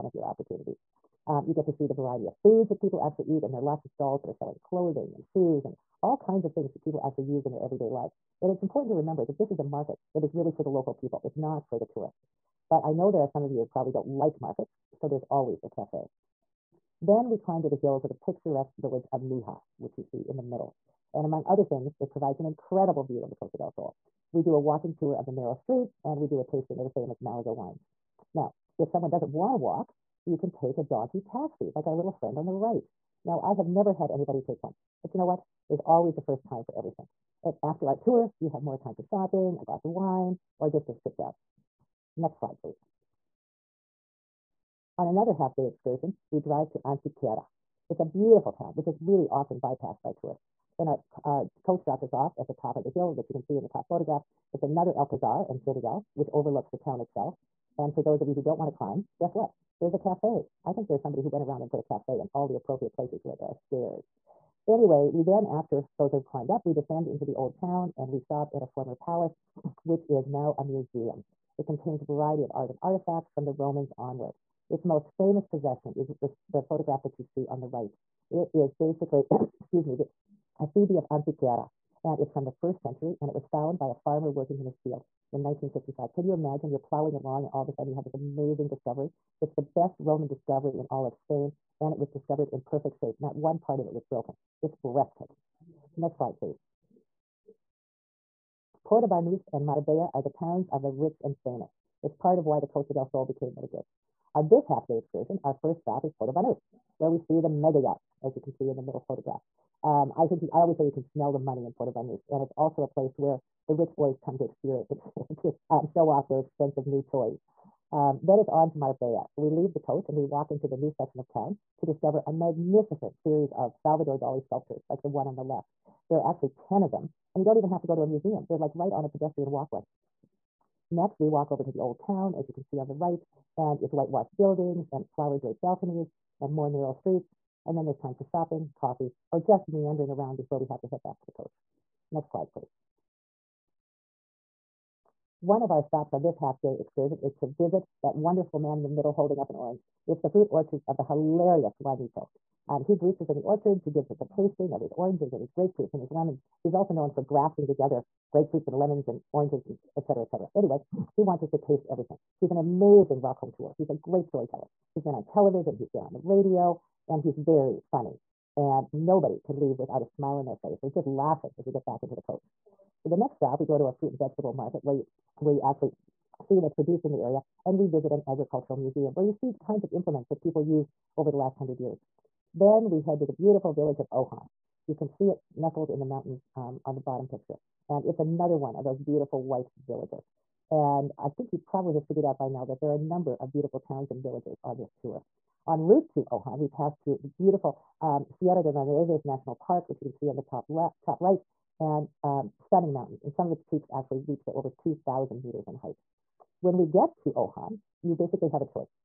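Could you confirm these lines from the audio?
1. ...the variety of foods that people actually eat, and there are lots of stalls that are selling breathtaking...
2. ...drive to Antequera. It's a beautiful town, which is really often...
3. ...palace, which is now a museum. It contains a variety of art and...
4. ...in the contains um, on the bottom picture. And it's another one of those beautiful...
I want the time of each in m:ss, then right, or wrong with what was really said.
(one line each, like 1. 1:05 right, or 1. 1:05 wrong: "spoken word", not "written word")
1. 0:01 wrong: "clothing", not "breathtaking"
2. 0:46 right
3. 1:09 right
4. 3:05 wrong: "mountains", not "contains".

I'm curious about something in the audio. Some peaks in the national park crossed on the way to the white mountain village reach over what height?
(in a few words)
2,000 meters.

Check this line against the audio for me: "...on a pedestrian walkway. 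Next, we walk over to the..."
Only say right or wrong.
right.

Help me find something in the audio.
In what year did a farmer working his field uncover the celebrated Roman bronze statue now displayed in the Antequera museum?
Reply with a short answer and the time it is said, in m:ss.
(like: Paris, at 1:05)
1955, at 1:25.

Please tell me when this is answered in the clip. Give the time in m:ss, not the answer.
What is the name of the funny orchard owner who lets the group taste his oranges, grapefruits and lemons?
2:31.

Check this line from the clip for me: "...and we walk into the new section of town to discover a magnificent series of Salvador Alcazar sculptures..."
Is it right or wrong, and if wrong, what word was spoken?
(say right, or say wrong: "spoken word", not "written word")
wrong: "Dali", not "Alcazar".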